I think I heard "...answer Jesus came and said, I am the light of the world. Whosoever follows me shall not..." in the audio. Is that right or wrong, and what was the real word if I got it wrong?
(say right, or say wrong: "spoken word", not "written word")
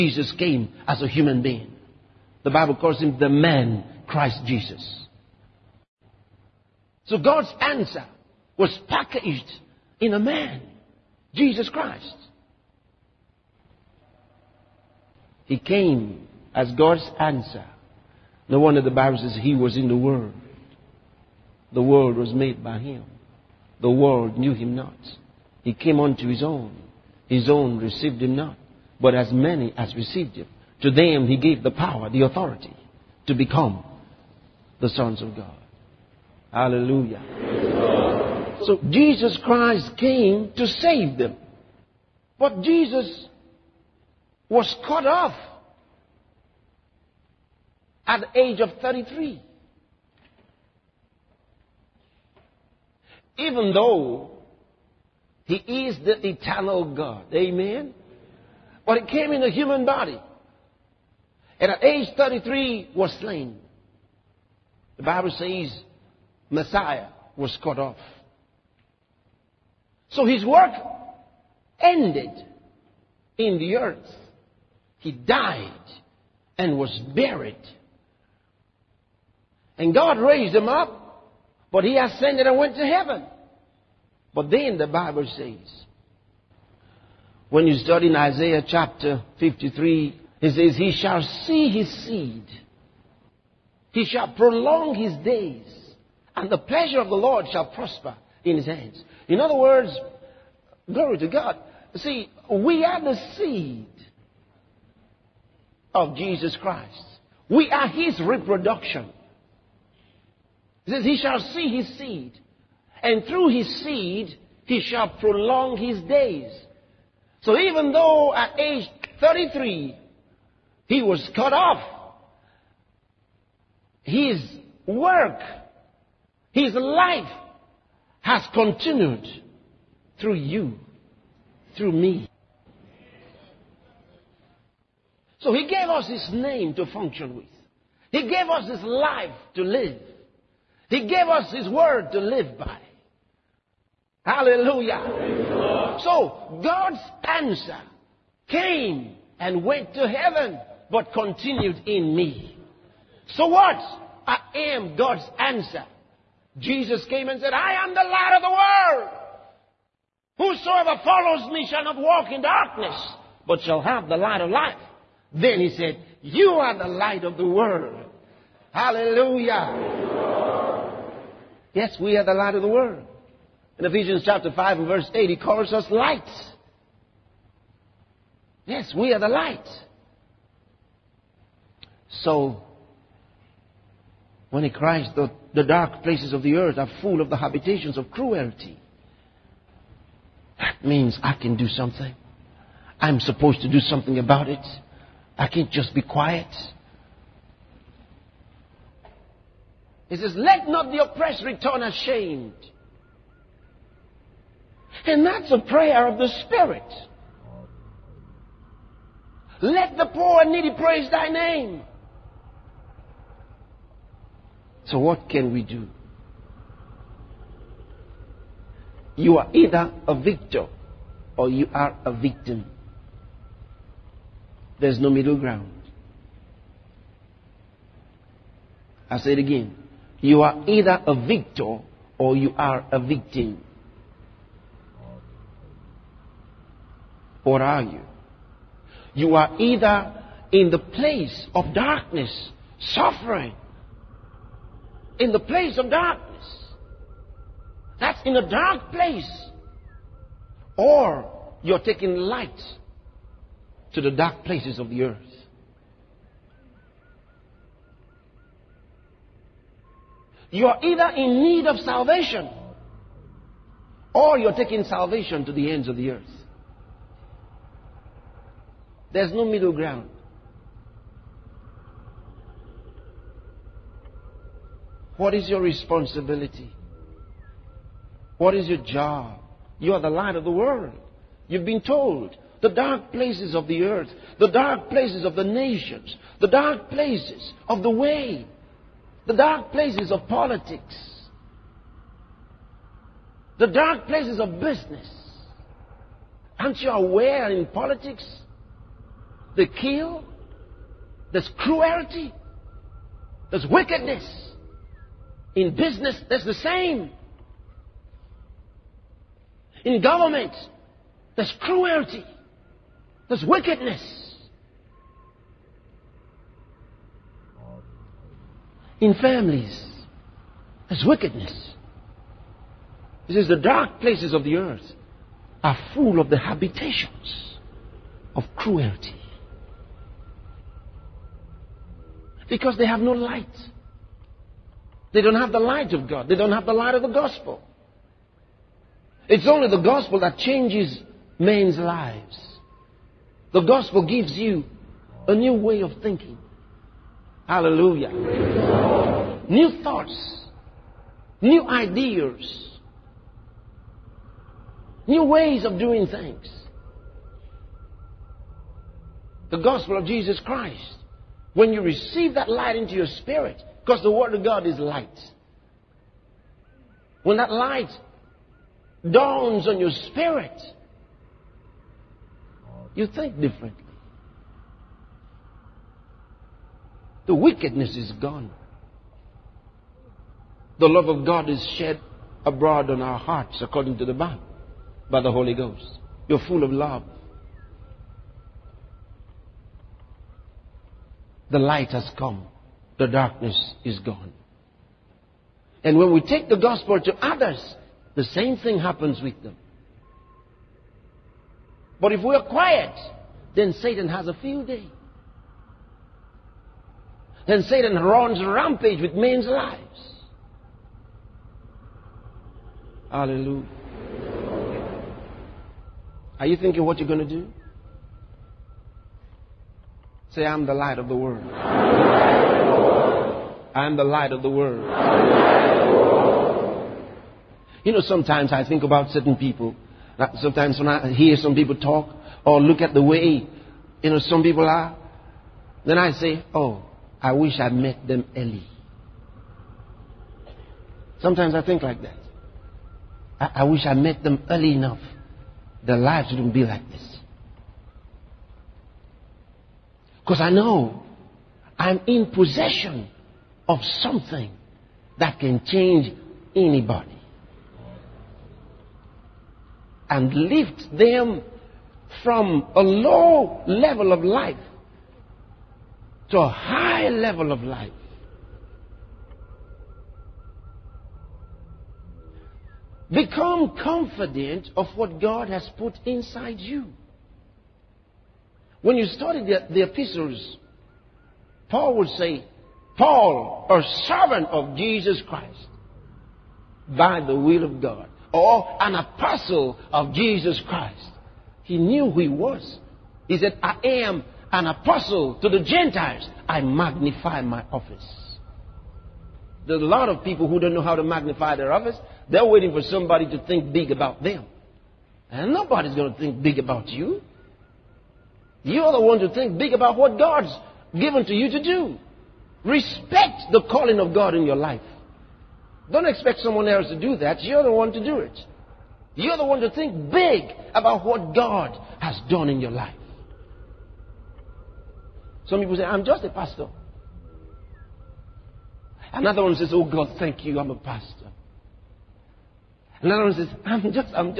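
right.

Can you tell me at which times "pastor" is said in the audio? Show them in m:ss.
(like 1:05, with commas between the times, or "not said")
8:46, 8:50.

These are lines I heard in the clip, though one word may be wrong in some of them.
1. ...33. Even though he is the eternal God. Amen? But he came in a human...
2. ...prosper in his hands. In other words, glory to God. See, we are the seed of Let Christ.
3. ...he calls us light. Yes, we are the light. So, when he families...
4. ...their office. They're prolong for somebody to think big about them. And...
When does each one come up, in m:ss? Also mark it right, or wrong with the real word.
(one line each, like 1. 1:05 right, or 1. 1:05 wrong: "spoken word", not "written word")
1. 0:48 right
2. 1:37 wrong: "Jesus", not "Let"
3. 2:55 wrong: "cries", not "families"
4. 8:21 wrong: "waiting", not "prolong".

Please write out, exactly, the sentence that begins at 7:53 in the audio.
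Become confident of what God has put inside you.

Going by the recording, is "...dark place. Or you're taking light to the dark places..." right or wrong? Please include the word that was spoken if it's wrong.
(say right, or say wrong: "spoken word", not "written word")
right.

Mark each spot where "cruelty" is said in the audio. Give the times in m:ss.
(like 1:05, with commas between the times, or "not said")
3:08, 5:01, 5:11, 5:28.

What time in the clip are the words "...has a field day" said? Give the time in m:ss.
6:44.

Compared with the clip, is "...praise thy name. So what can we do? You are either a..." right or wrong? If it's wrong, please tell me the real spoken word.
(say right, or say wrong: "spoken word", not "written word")
right.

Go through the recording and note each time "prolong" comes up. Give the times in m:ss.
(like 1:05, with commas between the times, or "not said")
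1:34, 1:55.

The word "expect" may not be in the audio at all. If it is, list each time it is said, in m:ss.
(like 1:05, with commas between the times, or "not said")
8:36.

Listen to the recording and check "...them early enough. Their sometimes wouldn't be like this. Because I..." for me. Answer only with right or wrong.
wrong.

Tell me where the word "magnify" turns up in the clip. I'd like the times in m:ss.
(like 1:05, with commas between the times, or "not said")
8:16, 8:21.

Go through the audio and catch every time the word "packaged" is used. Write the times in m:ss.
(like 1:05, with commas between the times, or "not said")
0:08.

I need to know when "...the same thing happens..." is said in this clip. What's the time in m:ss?
6:38.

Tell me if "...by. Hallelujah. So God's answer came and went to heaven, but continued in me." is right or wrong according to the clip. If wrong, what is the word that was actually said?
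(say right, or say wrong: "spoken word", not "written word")
right.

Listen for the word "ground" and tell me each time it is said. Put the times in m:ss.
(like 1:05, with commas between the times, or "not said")
3:45, 4:29.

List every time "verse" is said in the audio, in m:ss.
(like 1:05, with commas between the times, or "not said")
2:54.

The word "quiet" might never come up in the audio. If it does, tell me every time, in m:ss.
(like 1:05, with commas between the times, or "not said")
3:16, 6:42.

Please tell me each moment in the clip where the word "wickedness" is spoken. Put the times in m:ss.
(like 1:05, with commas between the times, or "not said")
5:03, 5:13, 5:21, 6:17.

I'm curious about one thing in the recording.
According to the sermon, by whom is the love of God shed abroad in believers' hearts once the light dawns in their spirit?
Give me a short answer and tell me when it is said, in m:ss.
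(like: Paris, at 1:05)
Holy Ghost, at 6:25.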